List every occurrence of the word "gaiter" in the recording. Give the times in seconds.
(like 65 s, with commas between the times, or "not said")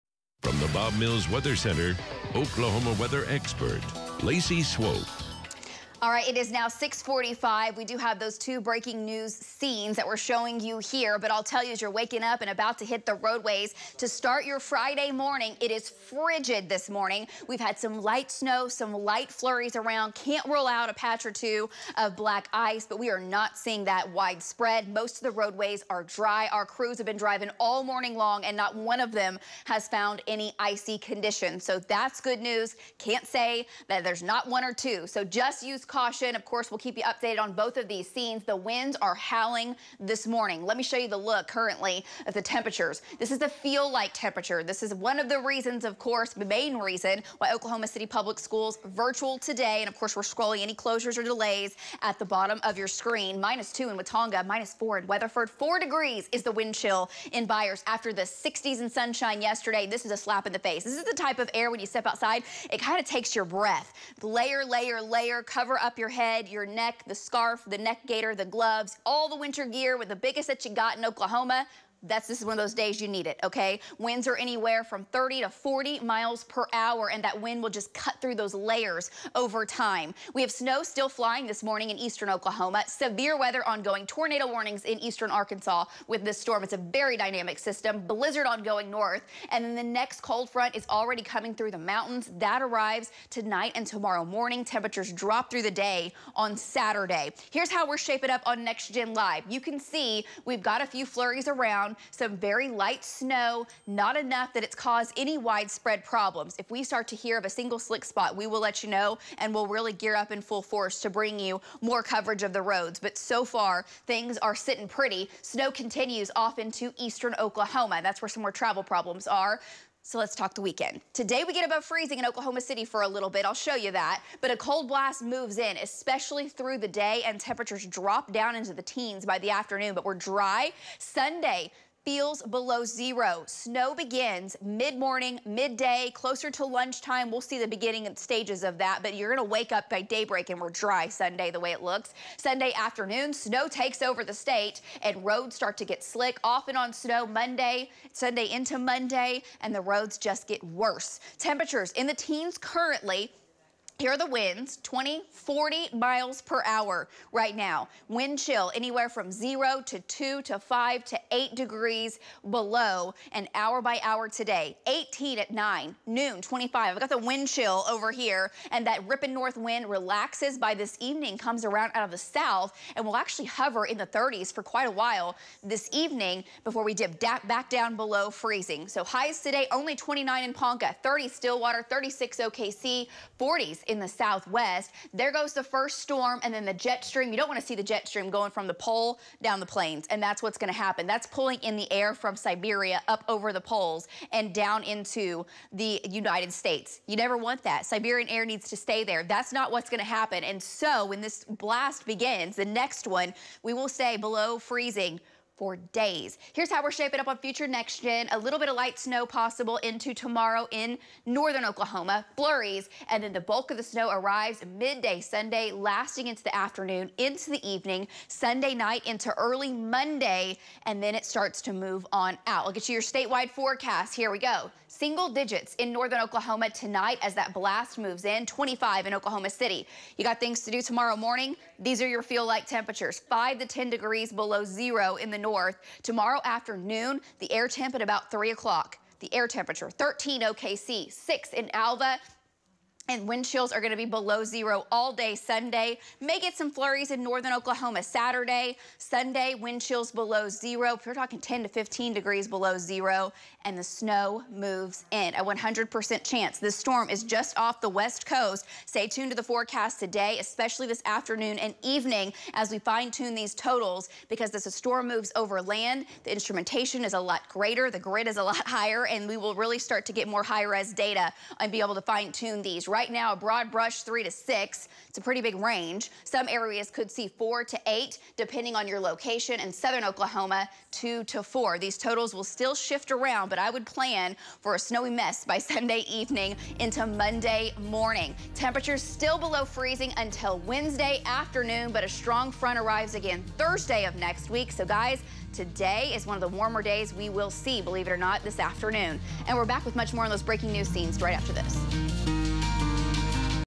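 68 s.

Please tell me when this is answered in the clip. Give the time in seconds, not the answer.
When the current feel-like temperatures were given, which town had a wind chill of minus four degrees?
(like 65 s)
55 s.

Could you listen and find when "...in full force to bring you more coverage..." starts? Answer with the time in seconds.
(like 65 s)
110 s.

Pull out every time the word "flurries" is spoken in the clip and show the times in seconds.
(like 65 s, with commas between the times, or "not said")
19 s, 101 s, 212 s, 246 s.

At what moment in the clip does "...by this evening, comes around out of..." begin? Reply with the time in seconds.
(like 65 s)
170 s.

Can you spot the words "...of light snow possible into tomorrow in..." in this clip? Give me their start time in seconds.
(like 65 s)
208 s.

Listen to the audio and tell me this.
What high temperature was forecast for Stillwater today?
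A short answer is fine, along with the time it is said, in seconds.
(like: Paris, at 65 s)
30, at 181 s.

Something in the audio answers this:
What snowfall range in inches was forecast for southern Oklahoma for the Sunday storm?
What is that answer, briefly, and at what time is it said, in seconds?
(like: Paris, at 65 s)
2 to 4, at 280 s.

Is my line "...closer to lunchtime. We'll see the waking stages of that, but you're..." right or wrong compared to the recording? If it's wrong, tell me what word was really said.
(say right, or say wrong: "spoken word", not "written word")
wrong: "beginning", not "waking".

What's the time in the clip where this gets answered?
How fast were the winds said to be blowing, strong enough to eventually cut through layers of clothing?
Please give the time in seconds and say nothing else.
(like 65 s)
75 s.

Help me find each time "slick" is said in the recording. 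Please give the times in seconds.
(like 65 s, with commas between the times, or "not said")
107 s, 146 s.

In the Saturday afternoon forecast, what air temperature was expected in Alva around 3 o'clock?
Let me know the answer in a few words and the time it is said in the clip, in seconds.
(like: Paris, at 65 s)
6, at 241 s.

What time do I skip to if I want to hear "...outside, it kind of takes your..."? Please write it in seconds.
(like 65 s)
62 s.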